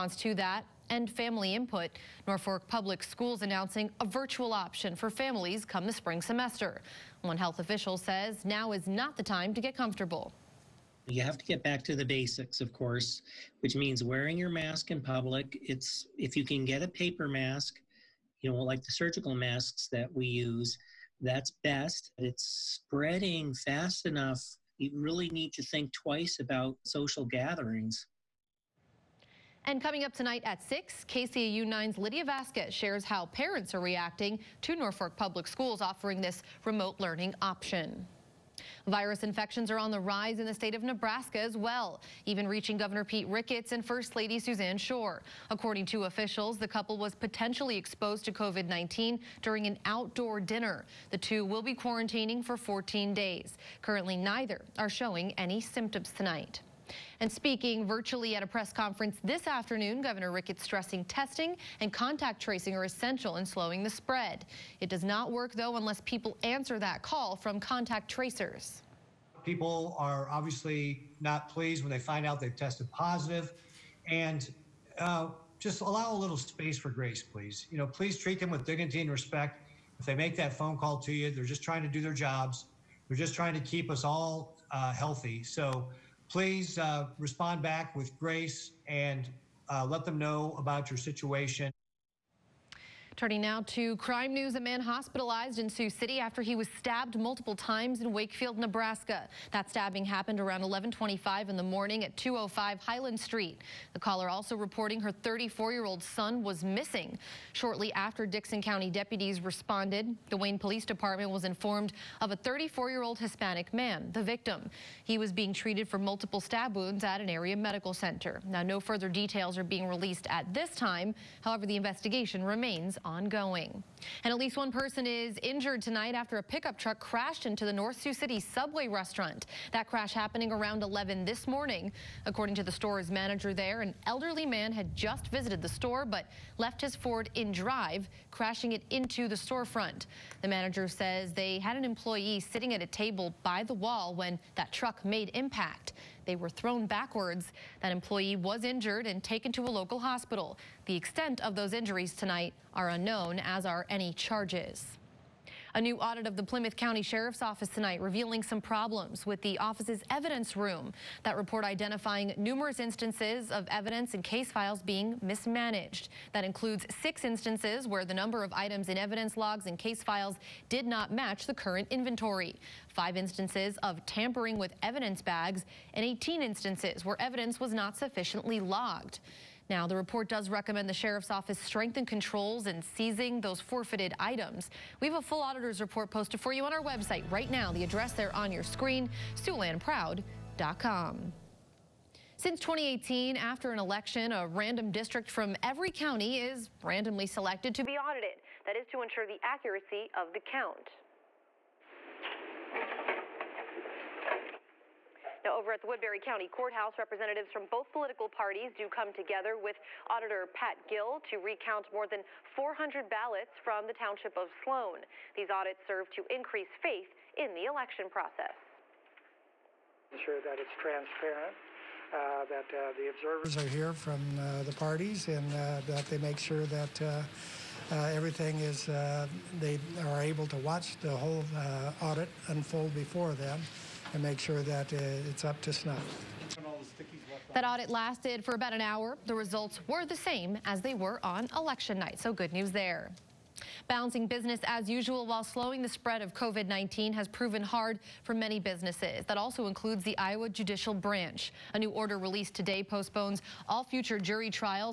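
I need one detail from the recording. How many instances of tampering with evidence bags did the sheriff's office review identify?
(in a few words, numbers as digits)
5.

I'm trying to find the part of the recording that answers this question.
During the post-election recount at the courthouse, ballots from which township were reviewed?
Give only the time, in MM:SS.
03:34.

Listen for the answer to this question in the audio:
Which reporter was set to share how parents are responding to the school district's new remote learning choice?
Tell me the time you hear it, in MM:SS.
00:31.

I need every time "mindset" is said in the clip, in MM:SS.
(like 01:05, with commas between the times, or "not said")
not said.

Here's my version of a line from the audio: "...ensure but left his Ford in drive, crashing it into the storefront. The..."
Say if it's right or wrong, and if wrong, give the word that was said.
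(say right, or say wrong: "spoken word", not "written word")
wrong: "store", not "ensure".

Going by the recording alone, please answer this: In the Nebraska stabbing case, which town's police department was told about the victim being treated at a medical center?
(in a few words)
Wayne.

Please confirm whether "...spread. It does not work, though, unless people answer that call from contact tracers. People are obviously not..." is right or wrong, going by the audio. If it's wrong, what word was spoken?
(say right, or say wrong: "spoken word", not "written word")
right.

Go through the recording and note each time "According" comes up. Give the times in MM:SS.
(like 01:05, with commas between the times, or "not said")
00:45, 02:12.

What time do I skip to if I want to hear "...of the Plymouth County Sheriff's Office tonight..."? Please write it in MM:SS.
02:36.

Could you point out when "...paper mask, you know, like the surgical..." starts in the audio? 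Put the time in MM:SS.
00:16.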